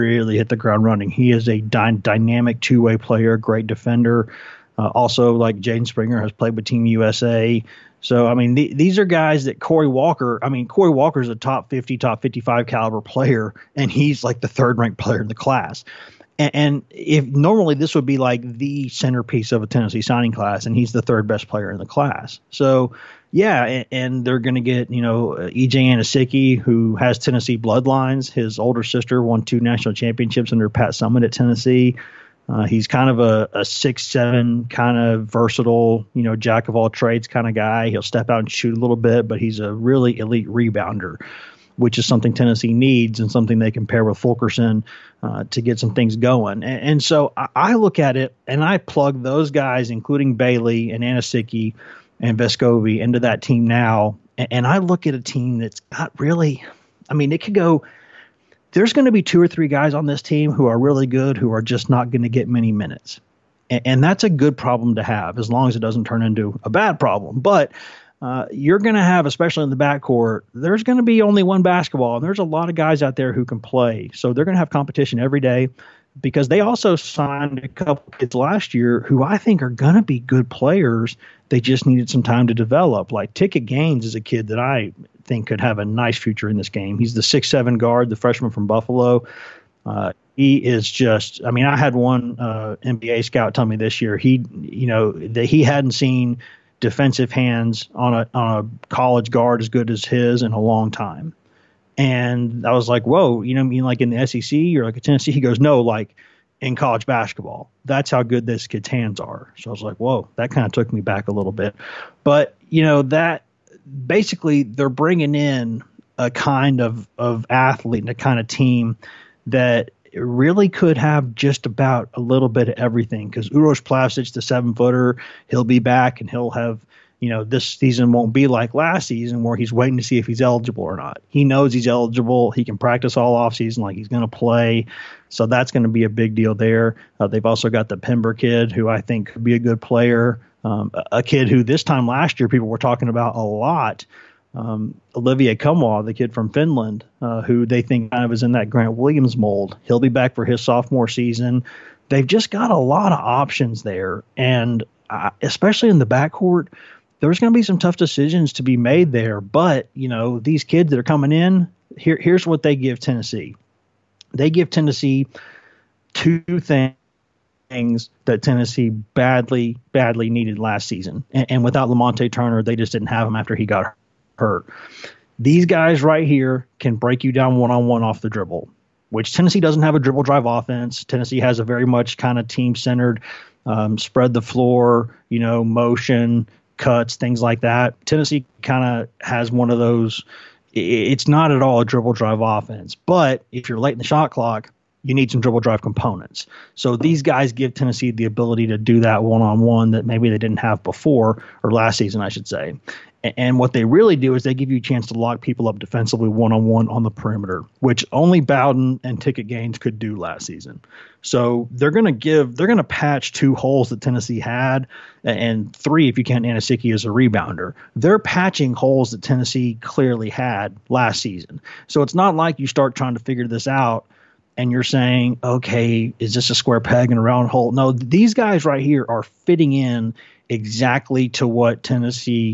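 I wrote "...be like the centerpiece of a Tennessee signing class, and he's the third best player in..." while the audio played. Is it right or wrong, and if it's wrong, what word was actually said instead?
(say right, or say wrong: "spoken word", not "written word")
right.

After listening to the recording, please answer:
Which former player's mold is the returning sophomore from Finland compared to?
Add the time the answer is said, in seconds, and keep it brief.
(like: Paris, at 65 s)
Grant Williams, at 148 s.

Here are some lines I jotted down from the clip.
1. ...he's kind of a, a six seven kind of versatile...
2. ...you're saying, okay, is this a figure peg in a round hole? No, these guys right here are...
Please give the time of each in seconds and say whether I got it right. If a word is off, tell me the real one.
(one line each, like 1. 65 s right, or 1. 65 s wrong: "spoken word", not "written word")
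1. 32 s right
2. 224 s wrong: "square", not "figure".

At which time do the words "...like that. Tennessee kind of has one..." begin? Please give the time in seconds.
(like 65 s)
187 s.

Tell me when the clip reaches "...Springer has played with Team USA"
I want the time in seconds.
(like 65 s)
5 s.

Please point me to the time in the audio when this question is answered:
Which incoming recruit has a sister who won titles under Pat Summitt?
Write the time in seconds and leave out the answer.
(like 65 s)
25 s.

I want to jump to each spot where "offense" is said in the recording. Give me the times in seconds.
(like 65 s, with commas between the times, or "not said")
180 s, 192 s.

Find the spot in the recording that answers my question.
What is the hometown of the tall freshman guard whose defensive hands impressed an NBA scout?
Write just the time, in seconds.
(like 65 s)
88 s.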